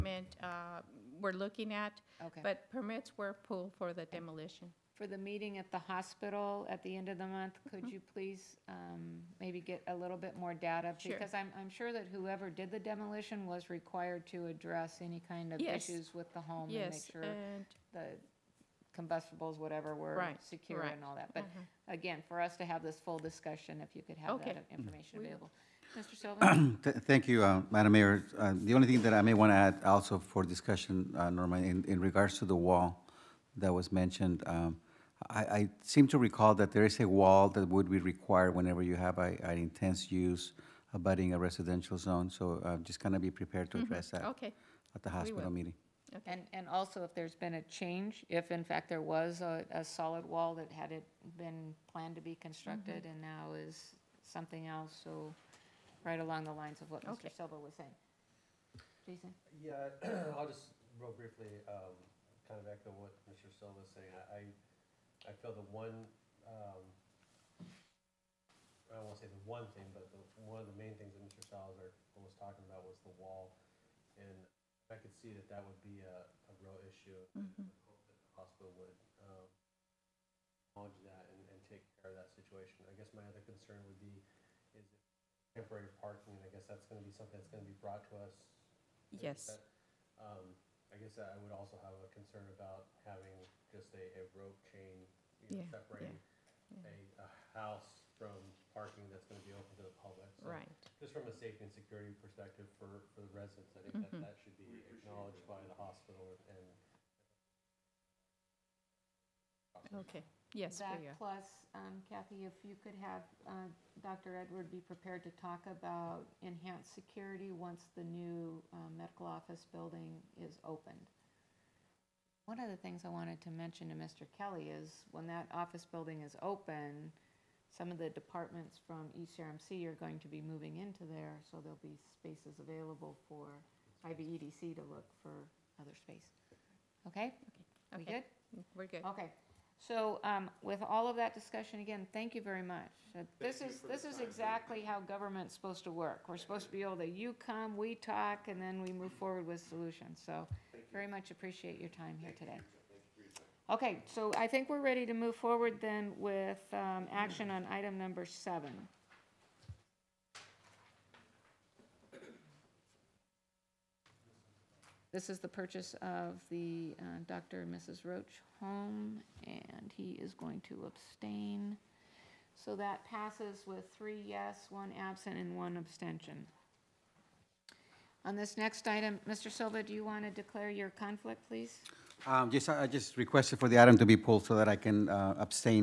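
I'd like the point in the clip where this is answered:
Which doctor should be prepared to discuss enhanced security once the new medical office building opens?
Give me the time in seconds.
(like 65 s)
114 s.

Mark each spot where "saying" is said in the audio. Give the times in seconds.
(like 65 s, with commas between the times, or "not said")
57 s, 63 s.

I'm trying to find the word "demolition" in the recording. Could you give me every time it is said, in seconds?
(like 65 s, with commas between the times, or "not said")
4 s, 12 s.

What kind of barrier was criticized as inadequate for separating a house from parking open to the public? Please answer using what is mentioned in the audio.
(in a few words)
a rope chain.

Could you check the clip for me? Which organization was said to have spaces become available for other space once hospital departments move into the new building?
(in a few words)
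IVEDC.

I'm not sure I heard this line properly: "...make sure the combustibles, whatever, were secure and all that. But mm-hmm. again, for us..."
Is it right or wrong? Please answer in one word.
right.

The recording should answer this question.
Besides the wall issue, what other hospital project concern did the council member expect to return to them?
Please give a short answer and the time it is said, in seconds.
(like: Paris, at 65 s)
temporary parking, at 85 s.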